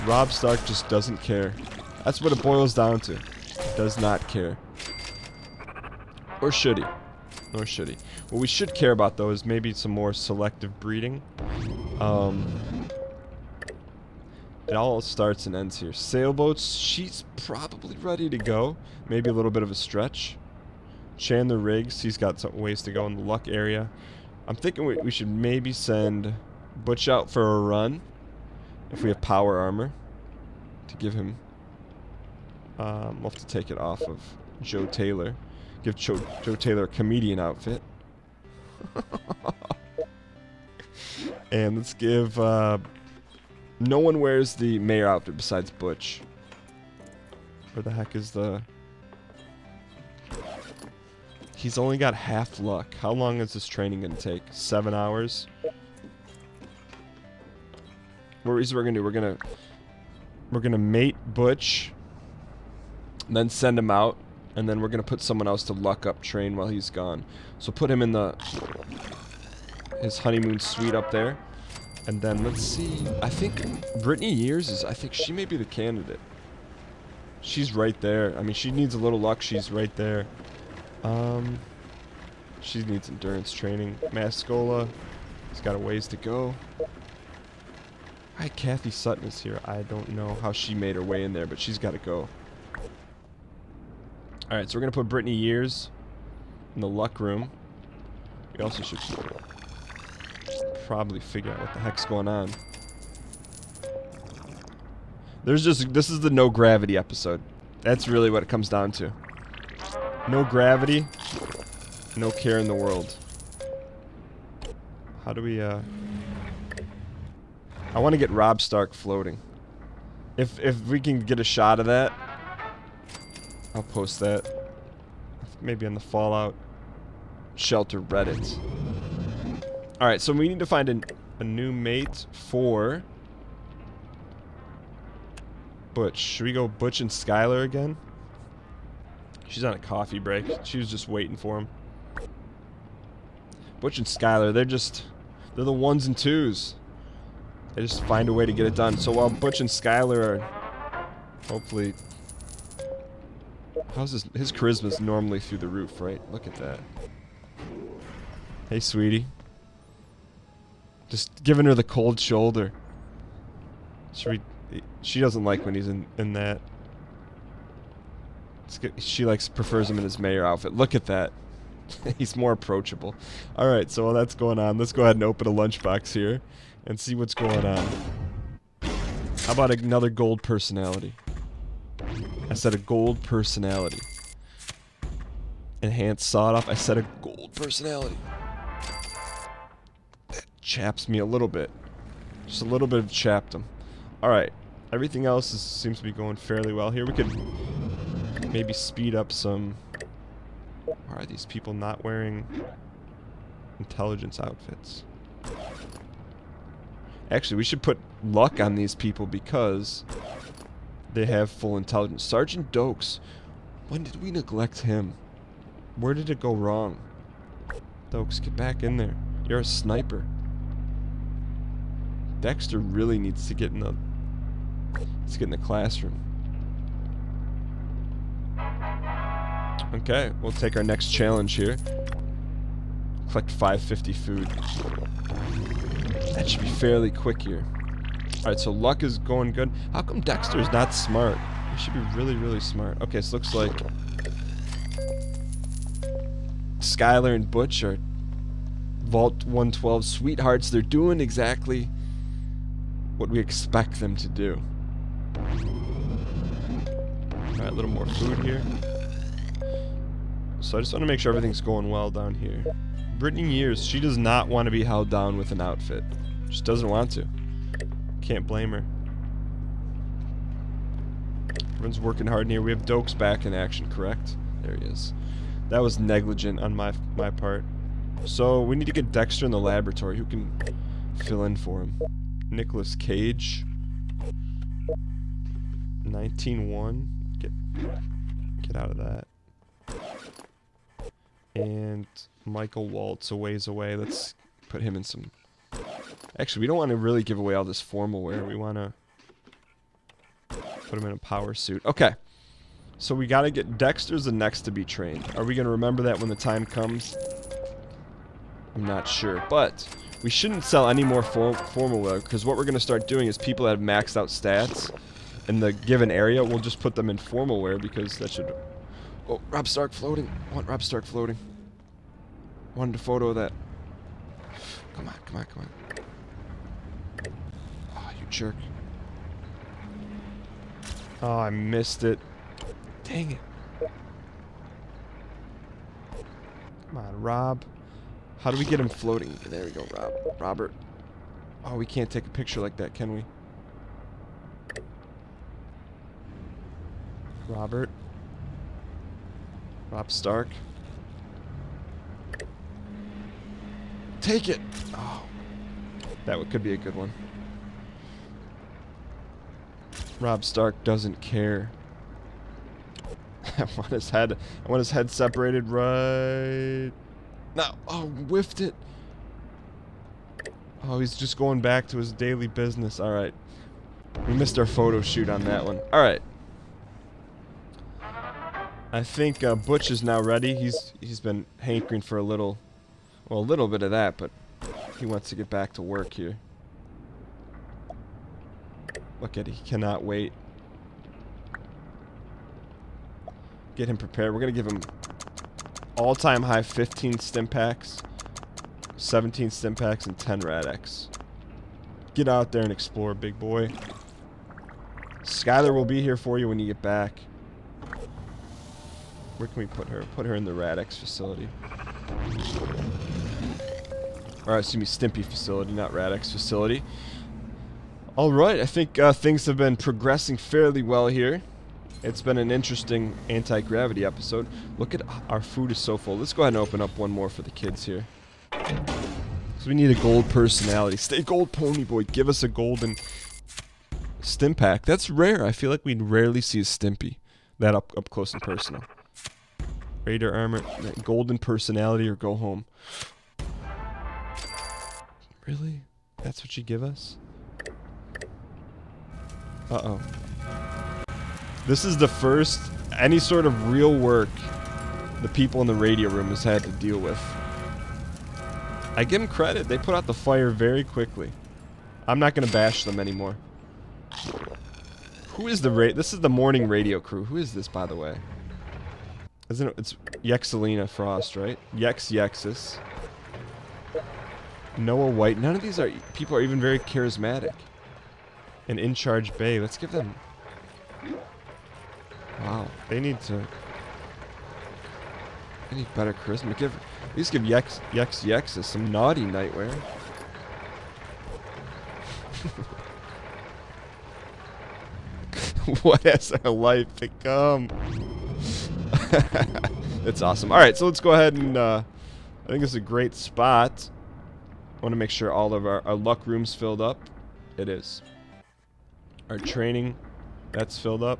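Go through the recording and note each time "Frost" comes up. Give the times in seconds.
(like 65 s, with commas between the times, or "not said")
470 s.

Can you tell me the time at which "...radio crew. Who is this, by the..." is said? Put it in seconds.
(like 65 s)
466 s.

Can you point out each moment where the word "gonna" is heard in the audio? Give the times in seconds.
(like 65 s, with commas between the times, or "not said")
394 s.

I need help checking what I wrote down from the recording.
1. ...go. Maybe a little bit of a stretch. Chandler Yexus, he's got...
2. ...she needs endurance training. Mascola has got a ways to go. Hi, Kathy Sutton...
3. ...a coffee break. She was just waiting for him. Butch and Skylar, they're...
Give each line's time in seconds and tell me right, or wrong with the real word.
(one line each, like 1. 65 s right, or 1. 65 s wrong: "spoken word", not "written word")
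1. 18 s wrong: "Riggs", not "Yexus"
2. 82 s right
3. 139 s right.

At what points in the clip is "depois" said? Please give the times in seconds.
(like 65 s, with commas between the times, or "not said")
not said.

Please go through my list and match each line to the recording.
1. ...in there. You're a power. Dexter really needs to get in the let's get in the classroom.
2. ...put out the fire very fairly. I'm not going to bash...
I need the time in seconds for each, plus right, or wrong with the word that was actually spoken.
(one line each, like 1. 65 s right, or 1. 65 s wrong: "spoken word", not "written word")
1. 218 s wrong: "sniper", not "power"
2. 459 s wrong: "quickly", not "fairly".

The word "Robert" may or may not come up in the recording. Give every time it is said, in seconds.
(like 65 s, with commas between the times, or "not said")
340 s, 347 s.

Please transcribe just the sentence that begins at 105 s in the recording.
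There's just, this is the no gravity episode.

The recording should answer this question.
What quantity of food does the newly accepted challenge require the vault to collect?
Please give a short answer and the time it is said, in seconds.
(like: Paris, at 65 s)
550, at 233 s.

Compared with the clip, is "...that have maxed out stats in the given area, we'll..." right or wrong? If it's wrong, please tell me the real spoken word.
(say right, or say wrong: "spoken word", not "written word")
right.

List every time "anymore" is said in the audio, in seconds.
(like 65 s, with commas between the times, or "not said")
462 s.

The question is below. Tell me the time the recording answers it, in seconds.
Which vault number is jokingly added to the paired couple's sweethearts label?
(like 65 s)
249 s.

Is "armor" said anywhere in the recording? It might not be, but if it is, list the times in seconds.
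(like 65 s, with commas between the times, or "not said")
29 s, 440 s.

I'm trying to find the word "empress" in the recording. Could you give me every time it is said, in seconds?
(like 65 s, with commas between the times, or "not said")
not said.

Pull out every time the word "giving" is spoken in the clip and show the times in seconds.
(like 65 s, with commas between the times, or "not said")
161 s.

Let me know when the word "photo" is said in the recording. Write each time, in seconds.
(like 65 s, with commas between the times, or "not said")
322 s, 374 s.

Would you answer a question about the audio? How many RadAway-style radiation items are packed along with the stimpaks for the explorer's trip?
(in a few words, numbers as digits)
10.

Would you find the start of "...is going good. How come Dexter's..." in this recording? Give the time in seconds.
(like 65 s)
239 s.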